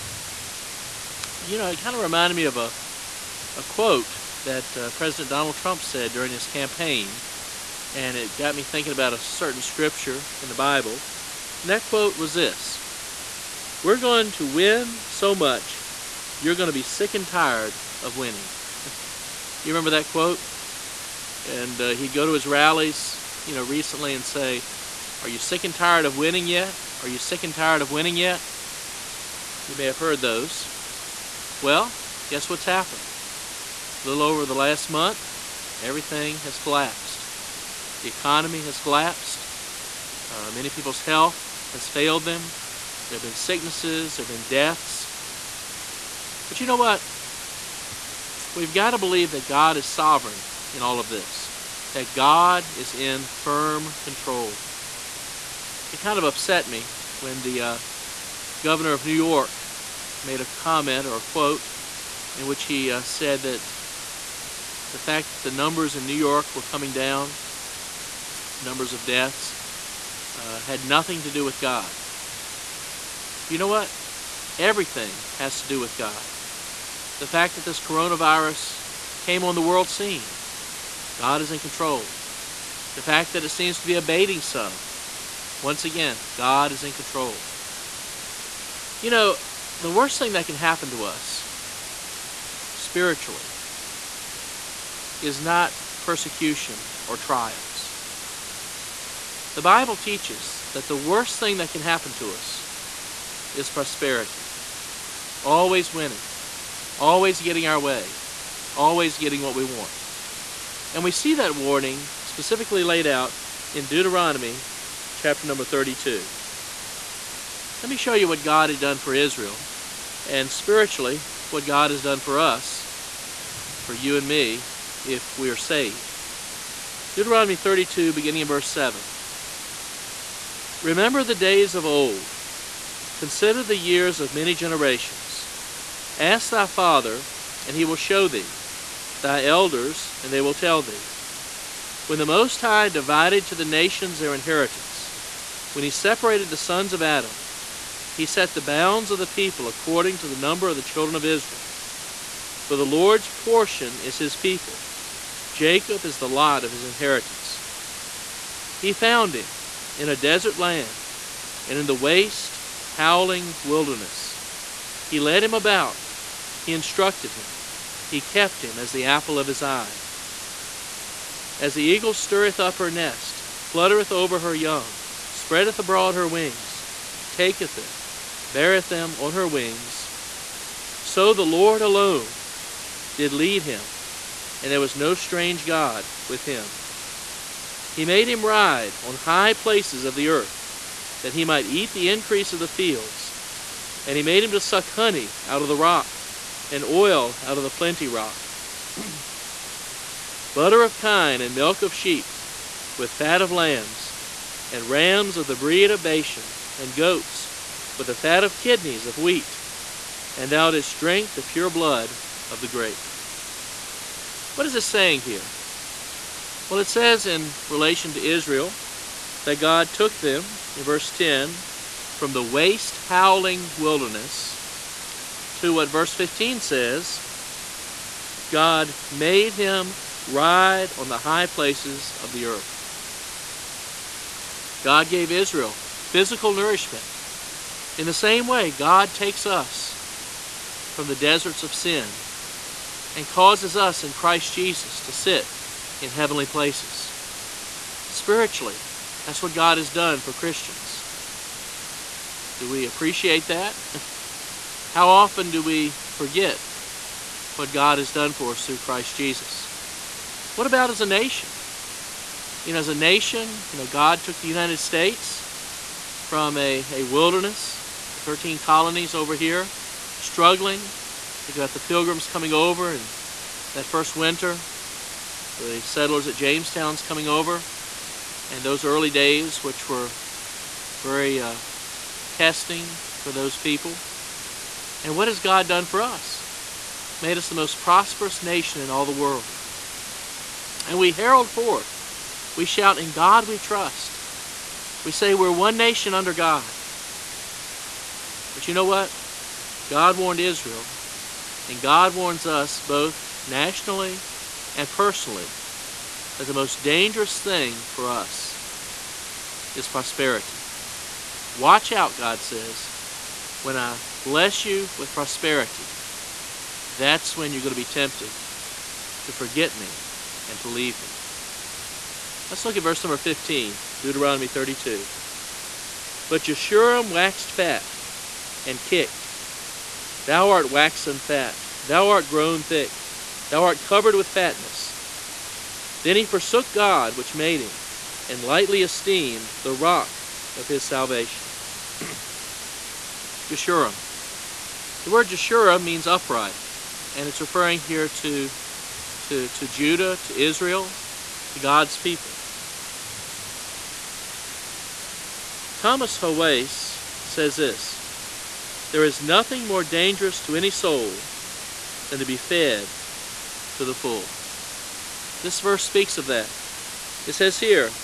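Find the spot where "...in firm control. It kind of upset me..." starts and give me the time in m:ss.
0:52.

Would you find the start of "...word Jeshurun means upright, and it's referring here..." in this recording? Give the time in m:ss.
5:45.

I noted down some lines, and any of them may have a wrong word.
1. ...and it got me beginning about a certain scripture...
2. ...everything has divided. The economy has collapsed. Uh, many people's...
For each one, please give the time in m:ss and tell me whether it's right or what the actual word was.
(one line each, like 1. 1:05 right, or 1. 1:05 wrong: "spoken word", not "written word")
1. 0:07 wrong: "thinking", not "beginning"
2. 0:35 wrong: "collapsed", not "divided".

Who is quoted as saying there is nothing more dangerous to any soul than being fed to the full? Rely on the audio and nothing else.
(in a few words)
Thomas Howace.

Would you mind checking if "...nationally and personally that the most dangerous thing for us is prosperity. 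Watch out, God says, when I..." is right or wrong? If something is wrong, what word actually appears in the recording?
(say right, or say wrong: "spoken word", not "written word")
right.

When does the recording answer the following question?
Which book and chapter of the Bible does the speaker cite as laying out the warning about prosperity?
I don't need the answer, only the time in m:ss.
1:53.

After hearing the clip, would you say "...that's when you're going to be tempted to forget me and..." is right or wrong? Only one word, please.
right.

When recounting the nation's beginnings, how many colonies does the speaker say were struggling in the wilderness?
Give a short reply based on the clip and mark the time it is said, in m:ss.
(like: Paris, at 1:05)
13, at 4:28.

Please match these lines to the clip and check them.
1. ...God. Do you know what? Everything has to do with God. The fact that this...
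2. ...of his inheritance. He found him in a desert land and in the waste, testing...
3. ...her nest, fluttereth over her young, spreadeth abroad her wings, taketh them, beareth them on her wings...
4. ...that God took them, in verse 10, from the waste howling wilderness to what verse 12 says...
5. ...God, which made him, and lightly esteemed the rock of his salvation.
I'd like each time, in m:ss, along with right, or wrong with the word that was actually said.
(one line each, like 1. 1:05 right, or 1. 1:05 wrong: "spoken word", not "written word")
1. 1:11 right
2. 2:36 wrong: "howling", not "testing"
3. 2:52 right
4. 3:39 wrong: "15", not "12"
5. 5:36 right.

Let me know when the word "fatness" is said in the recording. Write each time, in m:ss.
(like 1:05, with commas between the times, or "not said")
5:34.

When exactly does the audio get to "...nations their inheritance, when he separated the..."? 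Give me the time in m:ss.
2:23.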